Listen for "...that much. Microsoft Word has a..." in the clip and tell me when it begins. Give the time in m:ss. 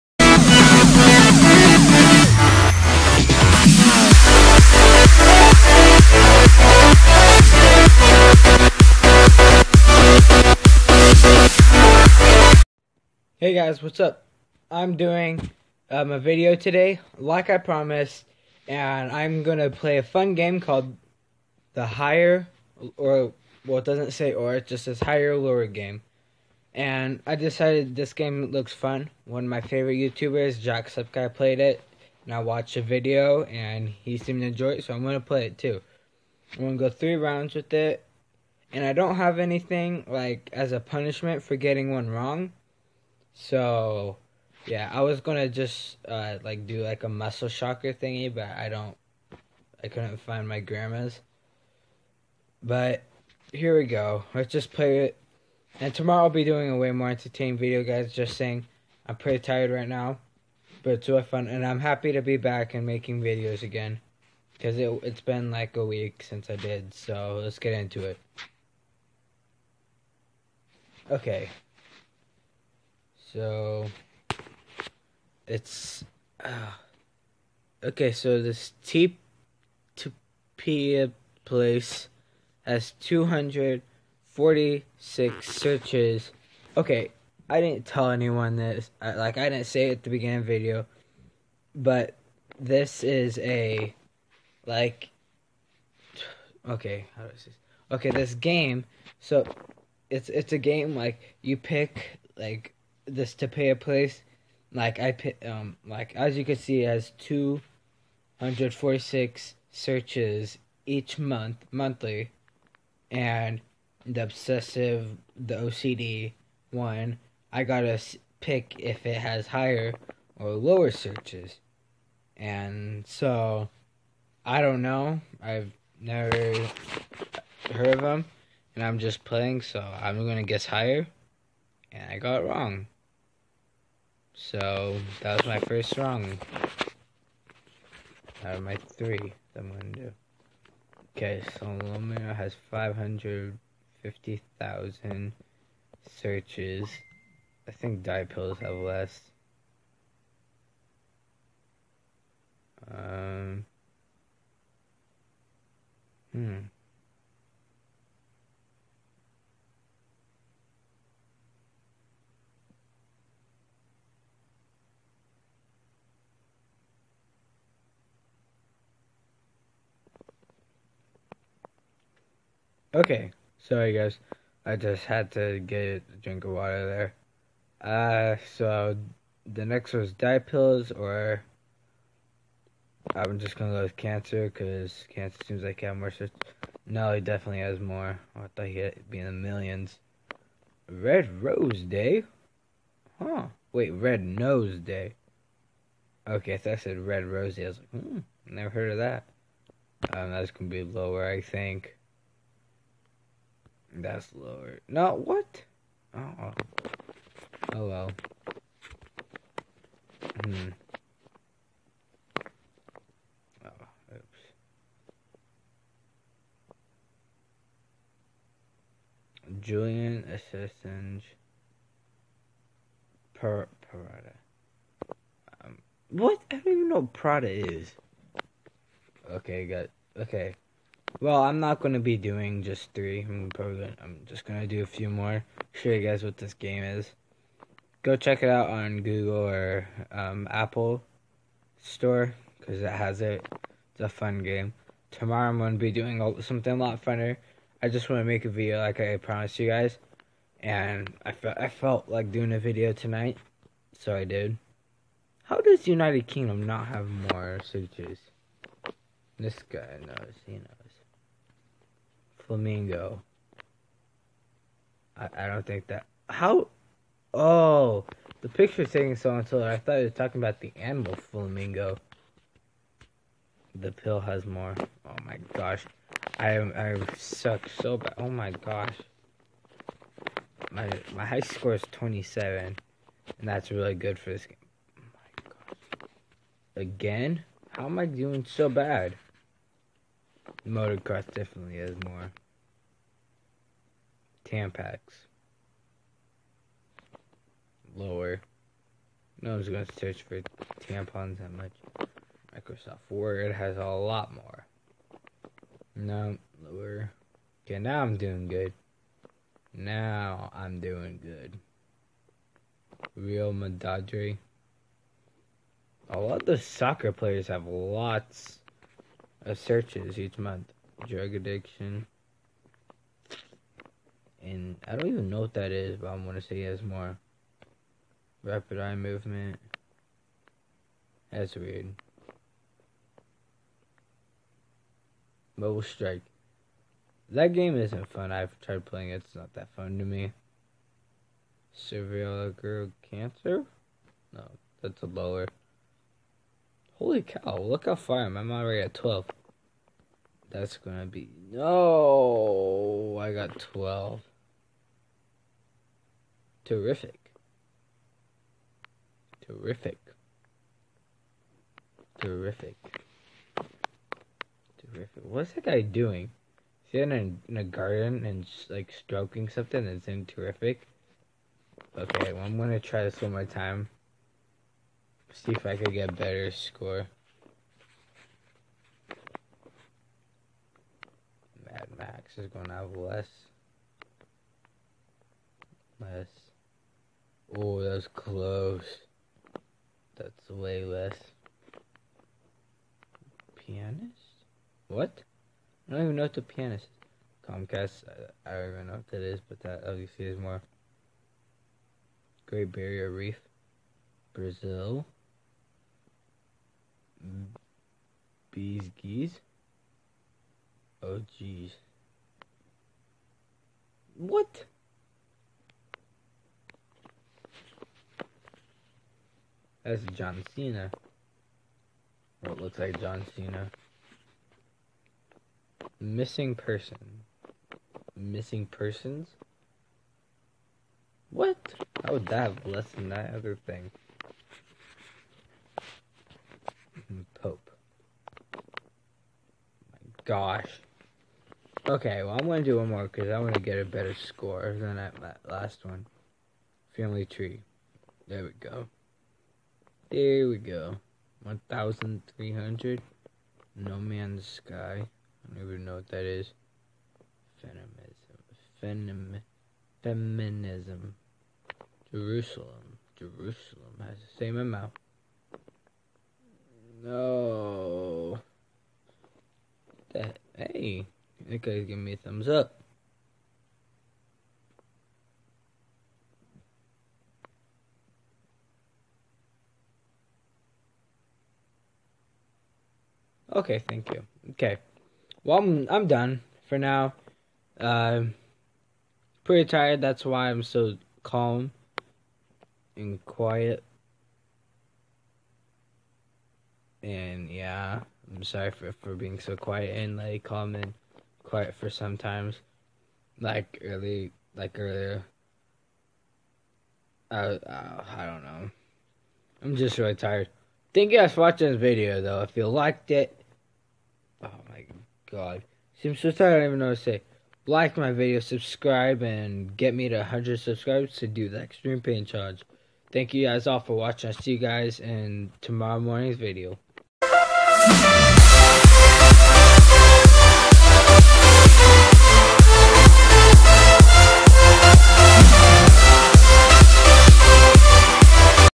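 5:01.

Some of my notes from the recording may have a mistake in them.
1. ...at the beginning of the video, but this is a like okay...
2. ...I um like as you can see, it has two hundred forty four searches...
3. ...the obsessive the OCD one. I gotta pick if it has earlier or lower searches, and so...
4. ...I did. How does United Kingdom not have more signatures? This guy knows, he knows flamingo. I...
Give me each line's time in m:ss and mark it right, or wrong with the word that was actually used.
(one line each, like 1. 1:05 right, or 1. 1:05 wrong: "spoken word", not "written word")
1. 1:29 right
2. 1:44 wrong: "six", not "four"
3. 1:54 wrong: "higher", not "earlier"
4. 4:14 right.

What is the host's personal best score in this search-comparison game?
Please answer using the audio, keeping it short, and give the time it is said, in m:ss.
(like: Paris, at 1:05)
27, at 4:41.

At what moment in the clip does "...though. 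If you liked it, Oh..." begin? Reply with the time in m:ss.
8:32.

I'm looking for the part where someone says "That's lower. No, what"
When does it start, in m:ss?
3:23.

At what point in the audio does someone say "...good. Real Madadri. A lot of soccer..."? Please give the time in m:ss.
5:11.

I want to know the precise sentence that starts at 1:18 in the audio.
So this T, T P place has two hundred forty six searches.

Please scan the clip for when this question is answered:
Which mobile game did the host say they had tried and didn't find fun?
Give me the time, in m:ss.
5:35.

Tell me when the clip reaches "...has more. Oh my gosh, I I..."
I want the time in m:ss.
4:34.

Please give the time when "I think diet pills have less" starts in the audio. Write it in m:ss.
2:27.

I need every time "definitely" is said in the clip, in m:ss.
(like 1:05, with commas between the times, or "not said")
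3:07, 4:51.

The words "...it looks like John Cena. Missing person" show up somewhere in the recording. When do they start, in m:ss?
7:02.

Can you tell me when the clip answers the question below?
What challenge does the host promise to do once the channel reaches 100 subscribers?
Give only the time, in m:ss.
8:41.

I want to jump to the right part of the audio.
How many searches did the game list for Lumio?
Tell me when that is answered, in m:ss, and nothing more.
2:22.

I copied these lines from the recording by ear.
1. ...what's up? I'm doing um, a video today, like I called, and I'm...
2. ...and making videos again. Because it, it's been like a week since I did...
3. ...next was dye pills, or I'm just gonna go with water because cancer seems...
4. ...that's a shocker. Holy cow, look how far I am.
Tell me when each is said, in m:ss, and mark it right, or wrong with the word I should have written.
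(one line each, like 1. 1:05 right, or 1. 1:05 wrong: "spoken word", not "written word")
1. 0:13 wrong: "promised", not "called"
2. 1:02 right
3. 2:59 wrong: "cancer", not "water"
4. 5:44 wrong: "lower", not "shocker".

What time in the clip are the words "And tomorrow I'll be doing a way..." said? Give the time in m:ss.
0:55.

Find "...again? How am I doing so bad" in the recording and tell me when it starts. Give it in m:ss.
4:46.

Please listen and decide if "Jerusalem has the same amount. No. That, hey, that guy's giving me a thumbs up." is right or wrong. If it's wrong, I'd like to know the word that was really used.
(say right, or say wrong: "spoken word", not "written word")
right.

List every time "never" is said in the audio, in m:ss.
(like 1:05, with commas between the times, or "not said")
2:05, 3:18.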